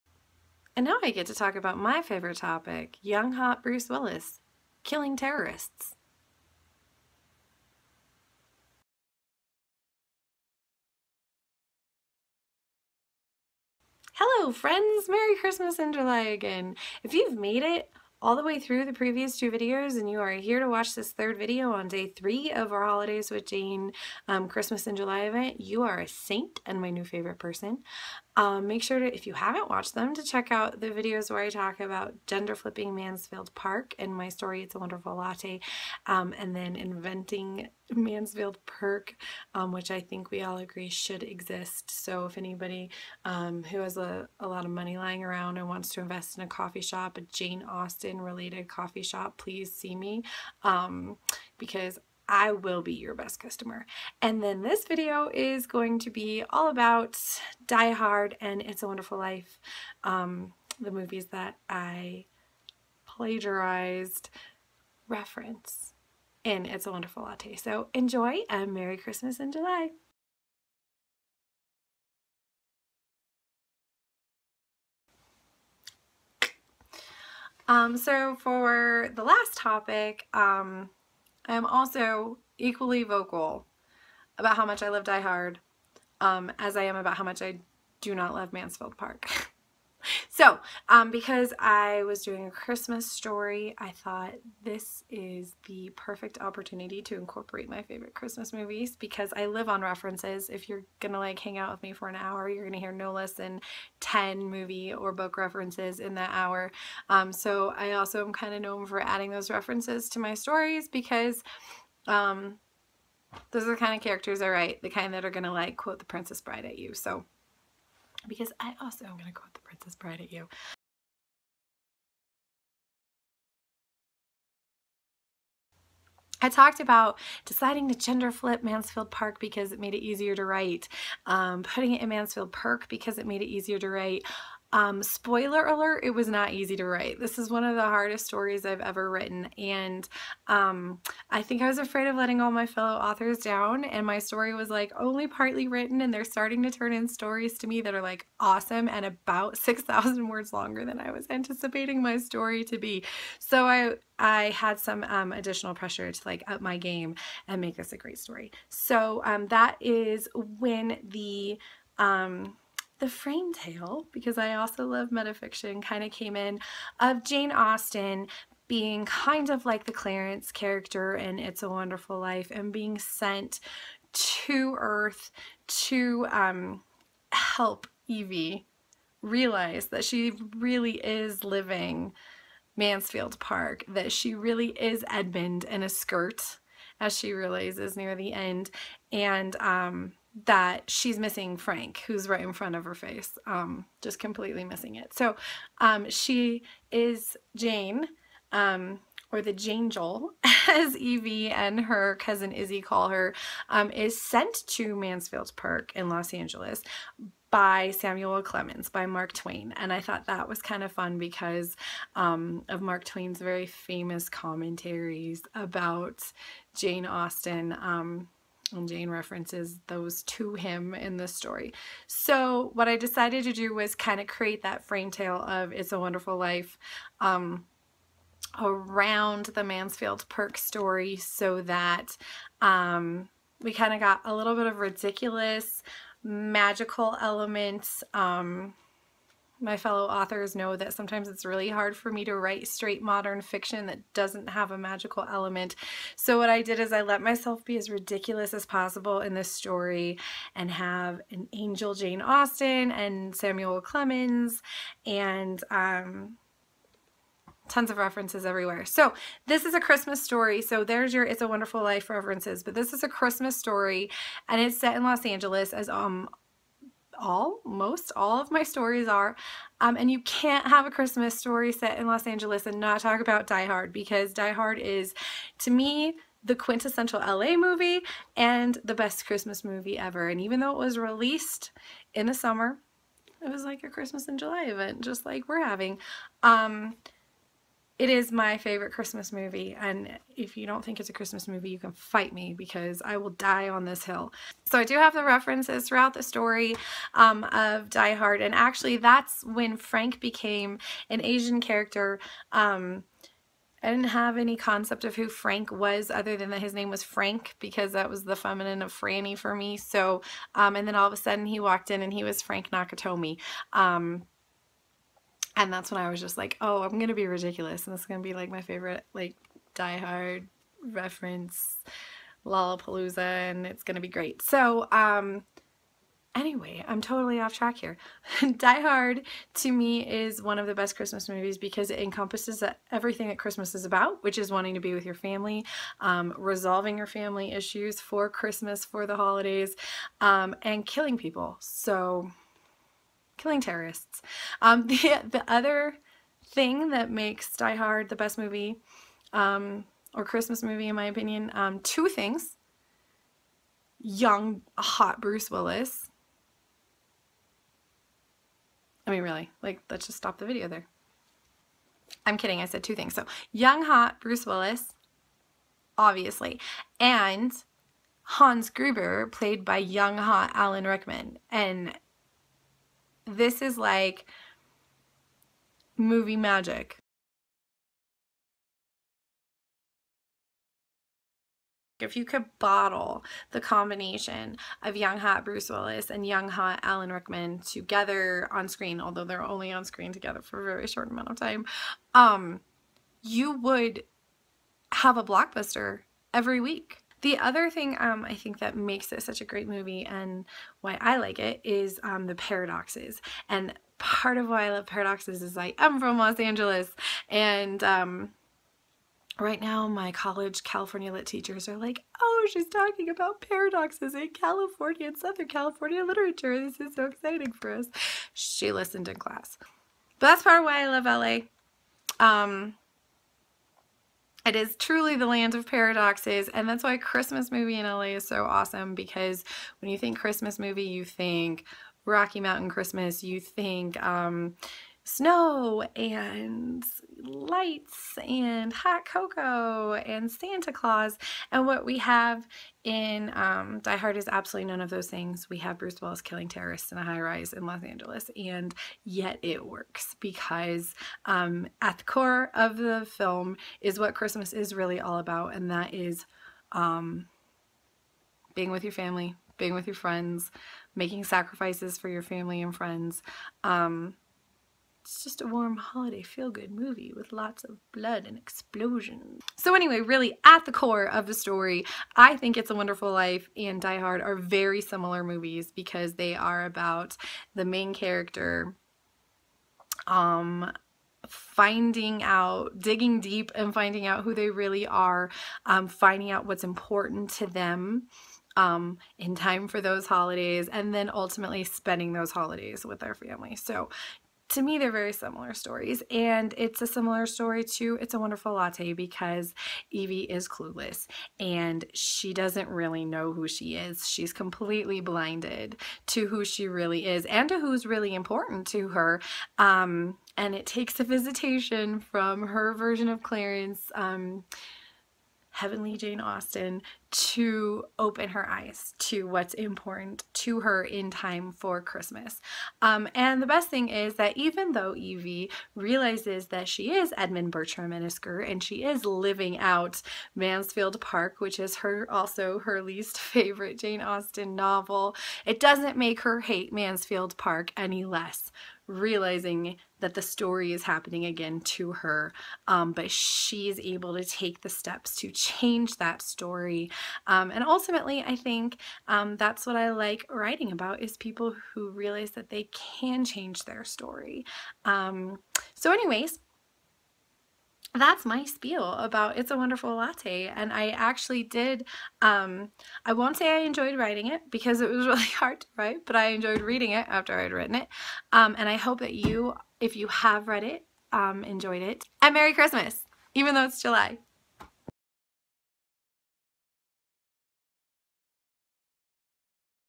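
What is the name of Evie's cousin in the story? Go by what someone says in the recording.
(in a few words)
Izzy.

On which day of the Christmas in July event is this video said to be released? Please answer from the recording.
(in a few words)
Day three.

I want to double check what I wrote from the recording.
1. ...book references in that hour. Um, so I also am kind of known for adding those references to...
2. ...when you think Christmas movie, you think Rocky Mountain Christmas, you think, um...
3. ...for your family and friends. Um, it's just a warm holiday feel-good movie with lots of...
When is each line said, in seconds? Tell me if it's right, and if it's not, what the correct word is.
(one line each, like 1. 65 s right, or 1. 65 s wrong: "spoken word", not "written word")
1. 105 s right
2. 429 s right
3. 461 s right.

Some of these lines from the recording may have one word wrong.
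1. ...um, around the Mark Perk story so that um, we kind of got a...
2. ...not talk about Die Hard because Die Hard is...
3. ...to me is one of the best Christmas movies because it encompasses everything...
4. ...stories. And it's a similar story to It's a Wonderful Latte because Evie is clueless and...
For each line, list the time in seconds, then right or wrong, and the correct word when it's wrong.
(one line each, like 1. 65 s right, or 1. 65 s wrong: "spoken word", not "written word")
1. 227 s wrong: "Mansfield", not "Mark"
2. 272 s right
3. 329 s right
4. 495 s right.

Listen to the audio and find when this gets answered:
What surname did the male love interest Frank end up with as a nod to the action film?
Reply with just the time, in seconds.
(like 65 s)
312 s.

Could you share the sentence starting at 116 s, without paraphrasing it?
So because I also am gonna quote the Princess Bride at you.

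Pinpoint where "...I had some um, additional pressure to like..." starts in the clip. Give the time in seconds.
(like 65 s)
154 s.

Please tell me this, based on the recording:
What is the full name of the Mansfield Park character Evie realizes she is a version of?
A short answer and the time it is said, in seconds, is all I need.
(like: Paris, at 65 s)
Edmund Bertram, at 527 s.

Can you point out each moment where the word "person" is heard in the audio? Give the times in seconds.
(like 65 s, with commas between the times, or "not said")
27 s.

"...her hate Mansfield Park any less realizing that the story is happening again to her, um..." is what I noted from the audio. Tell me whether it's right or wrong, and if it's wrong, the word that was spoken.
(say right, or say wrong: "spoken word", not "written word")
right.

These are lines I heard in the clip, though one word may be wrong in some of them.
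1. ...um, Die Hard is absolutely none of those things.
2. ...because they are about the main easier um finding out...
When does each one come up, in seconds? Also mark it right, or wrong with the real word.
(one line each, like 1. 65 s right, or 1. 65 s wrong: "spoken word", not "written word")
1. 443 s right
2. 475 s wrong: "character", not "easier".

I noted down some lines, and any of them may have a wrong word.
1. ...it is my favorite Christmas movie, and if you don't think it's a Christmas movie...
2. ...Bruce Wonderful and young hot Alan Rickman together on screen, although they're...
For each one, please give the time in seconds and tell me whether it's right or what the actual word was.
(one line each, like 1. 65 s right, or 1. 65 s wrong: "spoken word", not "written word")
1. 288 s right
2. 385 s wrong: "Willis", not "Wonderful".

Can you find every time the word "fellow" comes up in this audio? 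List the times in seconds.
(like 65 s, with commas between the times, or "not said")
142 s, 239 s.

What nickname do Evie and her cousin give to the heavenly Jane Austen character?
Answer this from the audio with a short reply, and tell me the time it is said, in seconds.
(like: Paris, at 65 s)
The Jangel, at 199 s.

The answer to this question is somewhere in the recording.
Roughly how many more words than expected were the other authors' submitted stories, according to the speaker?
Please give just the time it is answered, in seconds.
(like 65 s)
149 s.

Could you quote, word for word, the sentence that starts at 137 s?
This is one of the hardest stories I've ever written.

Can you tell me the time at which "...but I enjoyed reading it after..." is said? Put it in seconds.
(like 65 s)
566 s.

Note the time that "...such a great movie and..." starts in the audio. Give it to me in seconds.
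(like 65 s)
399 s.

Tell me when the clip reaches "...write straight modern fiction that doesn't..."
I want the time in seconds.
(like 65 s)
242 s.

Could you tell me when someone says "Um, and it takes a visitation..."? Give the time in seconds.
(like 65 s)
509 s.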